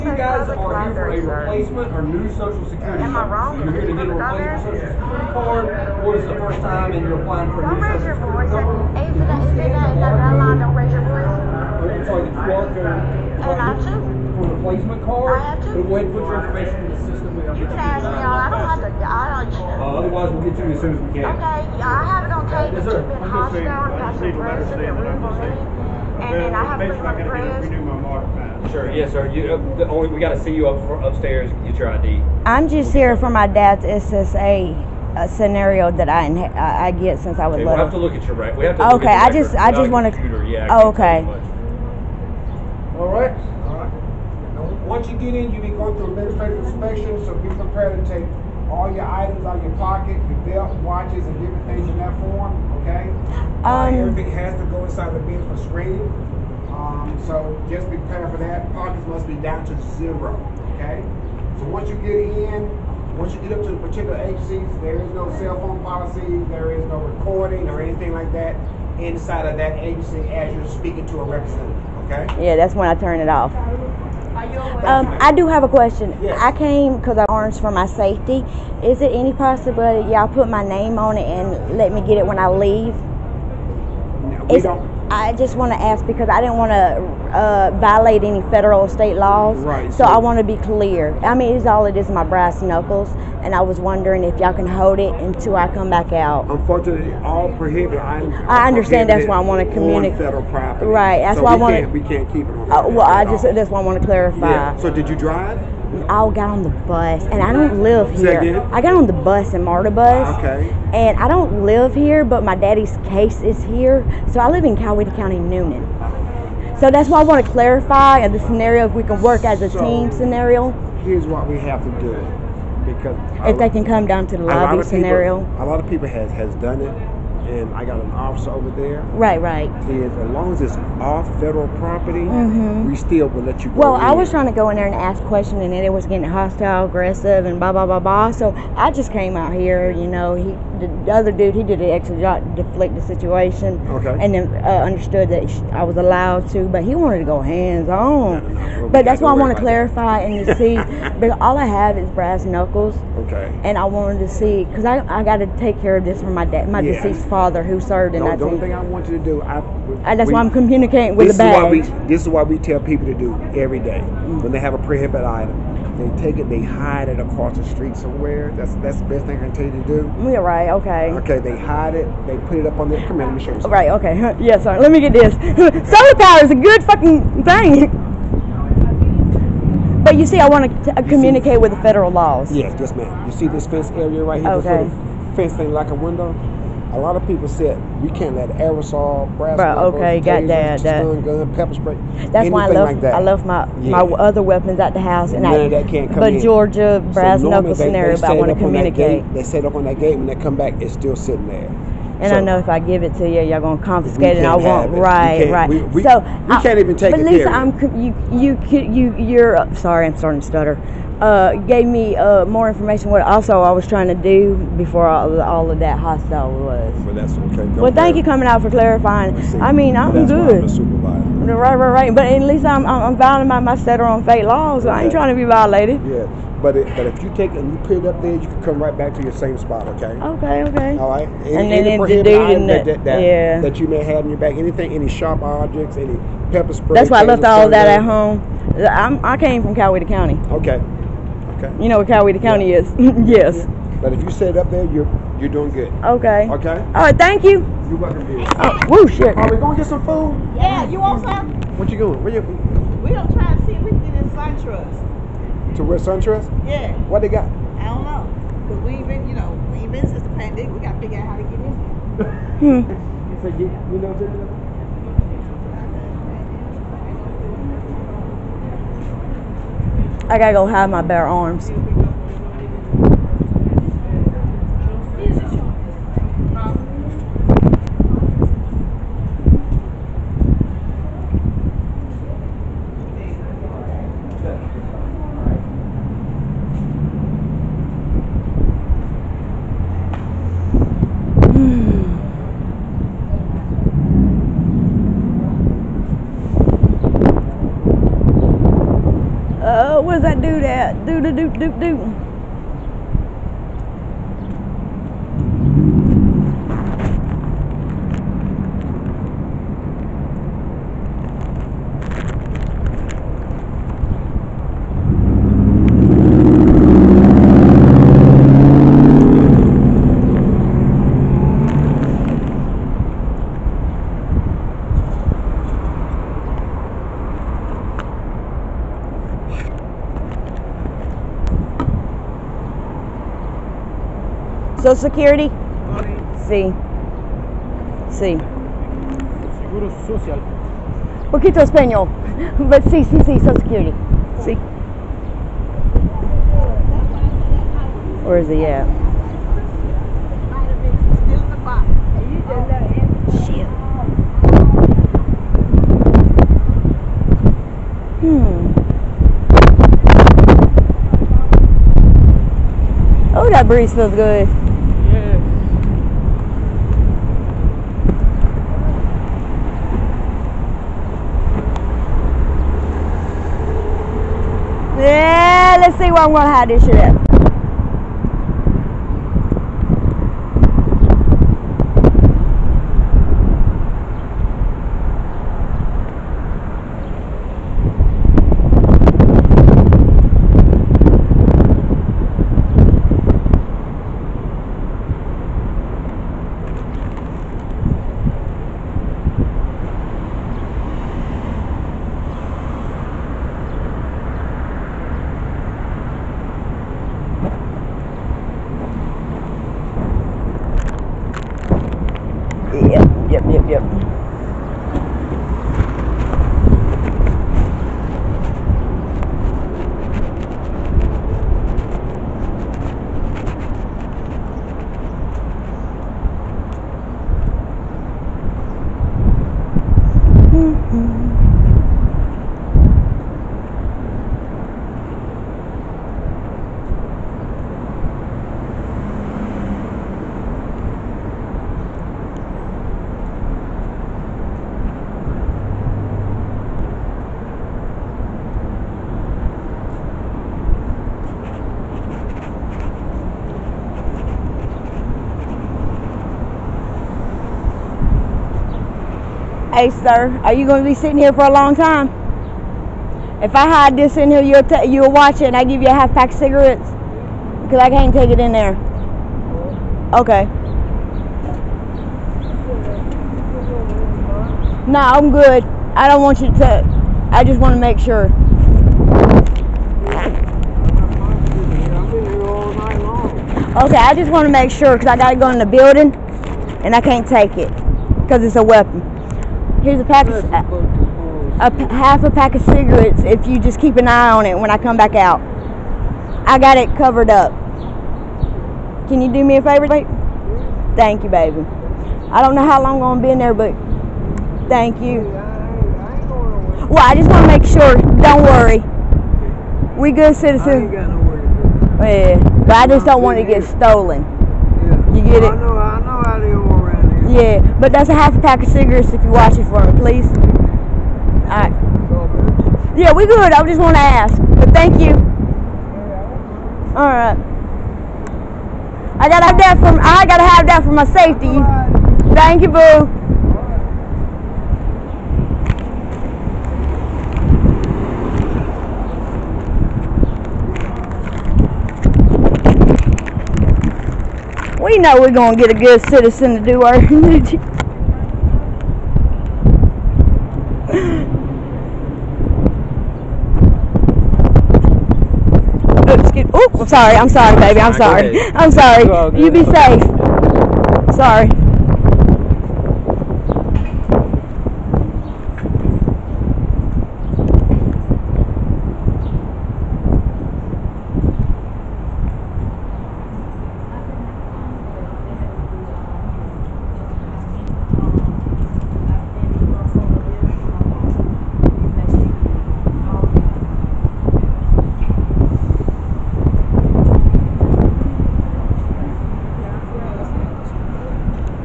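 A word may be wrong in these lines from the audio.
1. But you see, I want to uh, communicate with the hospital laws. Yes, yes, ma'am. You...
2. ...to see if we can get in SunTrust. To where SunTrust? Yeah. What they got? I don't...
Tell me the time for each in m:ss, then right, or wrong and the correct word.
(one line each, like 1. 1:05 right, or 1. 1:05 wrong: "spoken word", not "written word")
1. 3:00 wrong: "federal", not "hospital"
2. 4:13 right.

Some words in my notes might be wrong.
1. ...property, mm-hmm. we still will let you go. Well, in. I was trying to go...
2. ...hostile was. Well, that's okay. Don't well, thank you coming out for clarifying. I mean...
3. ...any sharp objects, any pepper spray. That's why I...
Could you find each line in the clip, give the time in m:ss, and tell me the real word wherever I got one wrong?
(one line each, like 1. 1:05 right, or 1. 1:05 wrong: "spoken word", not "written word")
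1. 2:11 right
2. 3:35 right
3. 3:54 right.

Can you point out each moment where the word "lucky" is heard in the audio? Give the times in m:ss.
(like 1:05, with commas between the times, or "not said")
not said.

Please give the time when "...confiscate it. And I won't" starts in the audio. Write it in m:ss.
3:23.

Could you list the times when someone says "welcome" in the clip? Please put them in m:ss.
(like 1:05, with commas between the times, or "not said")
4:07.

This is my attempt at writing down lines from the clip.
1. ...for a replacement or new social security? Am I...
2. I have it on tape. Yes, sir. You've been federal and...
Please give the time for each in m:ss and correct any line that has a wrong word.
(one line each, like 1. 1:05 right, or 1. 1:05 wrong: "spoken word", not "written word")
1. 0:00 right
2. 0:21 wrong: "hospital", not "federal".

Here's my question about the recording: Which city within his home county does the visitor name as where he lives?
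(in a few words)
Newnan.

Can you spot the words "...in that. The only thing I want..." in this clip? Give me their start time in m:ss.
2:38.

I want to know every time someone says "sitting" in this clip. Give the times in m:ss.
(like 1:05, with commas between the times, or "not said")
3:21, 7:40.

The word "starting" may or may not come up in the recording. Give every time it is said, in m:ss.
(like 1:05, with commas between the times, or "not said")
3:30.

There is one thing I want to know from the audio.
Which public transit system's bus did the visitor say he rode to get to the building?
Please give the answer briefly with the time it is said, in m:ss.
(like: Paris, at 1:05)
MARTA, at 1:49.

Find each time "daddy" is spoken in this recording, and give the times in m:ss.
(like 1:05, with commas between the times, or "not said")
1:52.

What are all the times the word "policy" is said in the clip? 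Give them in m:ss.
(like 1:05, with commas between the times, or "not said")
1:05.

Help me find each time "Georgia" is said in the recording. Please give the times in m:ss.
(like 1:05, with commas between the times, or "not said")
3:16.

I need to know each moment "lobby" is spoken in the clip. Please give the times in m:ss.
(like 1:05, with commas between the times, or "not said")
2:04.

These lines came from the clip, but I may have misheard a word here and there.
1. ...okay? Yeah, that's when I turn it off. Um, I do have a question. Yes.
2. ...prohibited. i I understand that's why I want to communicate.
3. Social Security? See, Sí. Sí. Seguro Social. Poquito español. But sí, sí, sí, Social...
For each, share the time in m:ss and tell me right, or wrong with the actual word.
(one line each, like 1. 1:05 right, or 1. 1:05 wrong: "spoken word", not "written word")
1. 1:12 right
2. 1:37 right
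3. 5:34 right.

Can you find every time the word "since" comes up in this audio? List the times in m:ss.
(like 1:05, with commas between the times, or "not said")
0:37, 4:20.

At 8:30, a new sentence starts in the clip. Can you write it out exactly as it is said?
Yeah, but I just don't want to get stolen.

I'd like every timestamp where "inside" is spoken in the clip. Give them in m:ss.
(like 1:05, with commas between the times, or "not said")
0:54, 1:08.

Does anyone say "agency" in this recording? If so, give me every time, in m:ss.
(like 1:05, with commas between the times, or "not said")
1:04, 1:09.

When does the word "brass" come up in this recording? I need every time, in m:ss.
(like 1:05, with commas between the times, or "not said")
1:32, 2:32, 3:09, 3:17.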